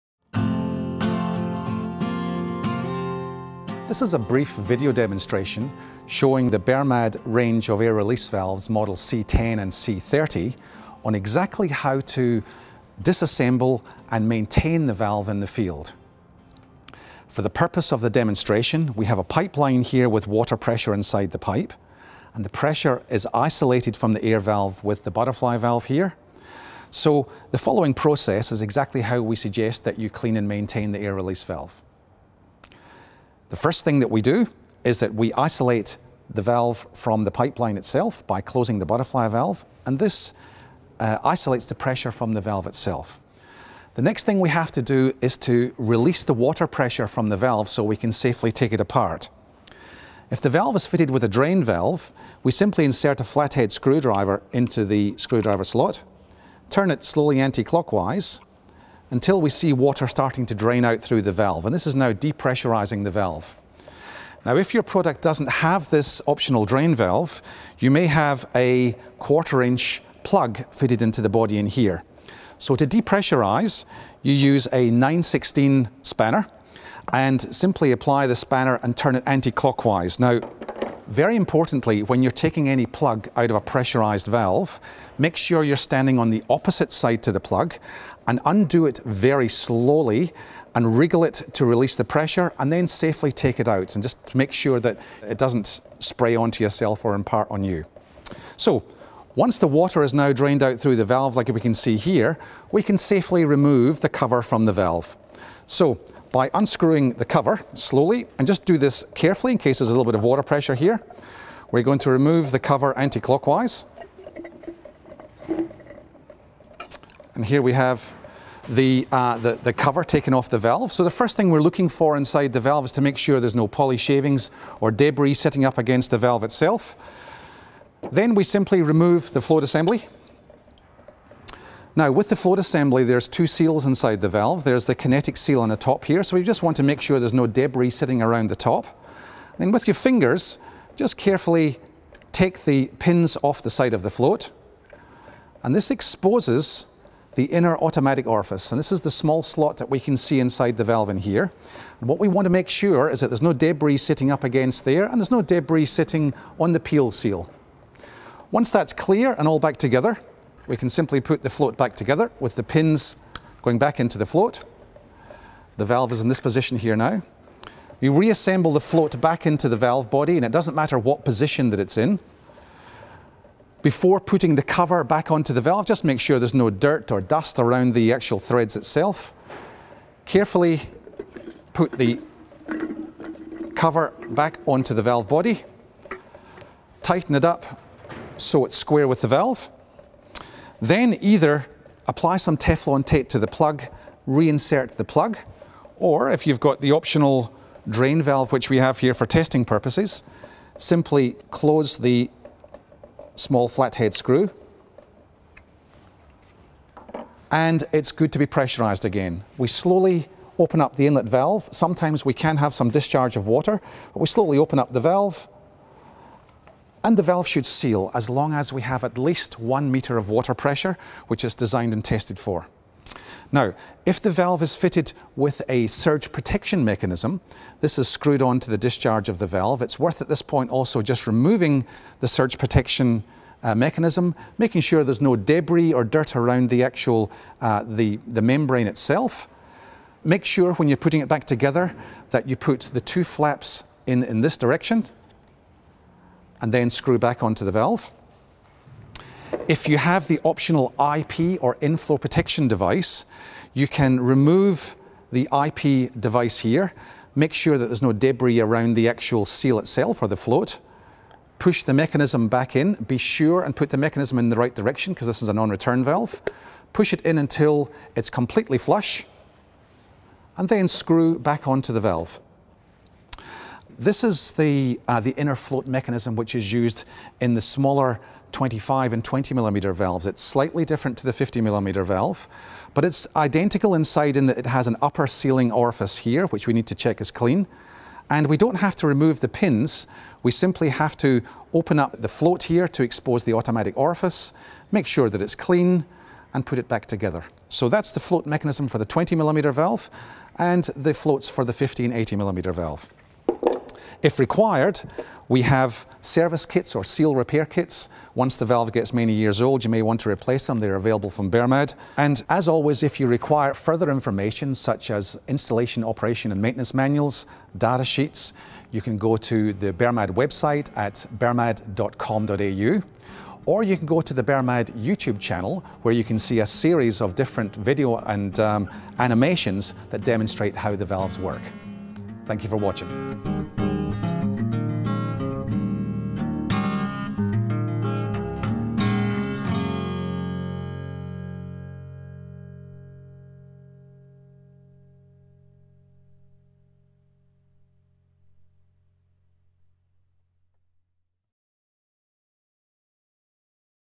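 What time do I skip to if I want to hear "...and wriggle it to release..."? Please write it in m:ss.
1:30.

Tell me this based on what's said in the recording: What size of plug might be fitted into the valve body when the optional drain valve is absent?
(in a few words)
Quarter inch.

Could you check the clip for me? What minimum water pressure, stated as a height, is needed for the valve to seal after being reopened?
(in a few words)
1 metre.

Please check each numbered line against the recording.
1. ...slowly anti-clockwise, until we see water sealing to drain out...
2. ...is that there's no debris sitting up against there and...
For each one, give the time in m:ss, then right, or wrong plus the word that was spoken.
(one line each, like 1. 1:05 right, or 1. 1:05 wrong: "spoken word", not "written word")
1. 0:57 wrong: "starting", not "sealing"
2. 2:33 right.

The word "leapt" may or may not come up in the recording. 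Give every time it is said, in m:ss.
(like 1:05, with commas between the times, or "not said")
not said.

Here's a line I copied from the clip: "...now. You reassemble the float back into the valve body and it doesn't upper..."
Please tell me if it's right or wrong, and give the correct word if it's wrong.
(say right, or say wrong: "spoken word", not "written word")
wrong: "matter", not "upper".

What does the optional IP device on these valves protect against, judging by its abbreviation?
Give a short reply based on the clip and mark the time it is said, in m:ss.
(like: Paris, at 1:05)
Inflow, at 4:11.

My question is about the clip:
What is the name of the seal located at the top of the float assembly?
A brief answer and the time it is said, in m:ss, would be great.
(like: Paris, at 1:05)
Kinetic seal, at 2:14.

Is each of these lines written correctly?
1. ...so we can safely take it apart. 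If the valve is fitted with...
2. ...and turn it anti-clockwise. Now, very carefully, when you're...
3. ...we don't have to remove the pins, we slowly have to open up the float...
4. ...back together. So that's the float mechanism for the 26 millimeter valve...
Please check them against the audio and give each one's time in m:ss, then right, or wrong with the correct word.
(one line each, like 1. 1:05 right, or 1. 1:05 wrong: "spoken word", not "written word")
1. 0:47 right
2. 1:18 wrong: "importantly", not "carefully"
3. 4:48 wrong: "simply", not "slowly"
4. 4:56 wrong: "20", not "26".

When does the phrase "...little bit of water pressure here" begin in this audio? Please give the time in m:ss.
1:49.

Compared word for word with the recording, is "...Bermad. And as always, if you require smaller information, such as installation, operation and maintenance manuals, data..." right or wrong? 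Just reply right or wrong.
wrong.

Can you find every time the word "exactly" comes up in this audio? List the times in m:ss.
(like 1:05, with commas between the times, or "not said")
0:11, 0:28.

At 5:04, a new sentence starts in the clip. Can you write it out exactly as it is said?
If required, we have service kits or seal repair kits.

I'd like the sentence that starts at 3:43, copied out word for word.
Now, if the valve is fitted with a surge protection mechanism, this is screwed onto the discharge of the valve.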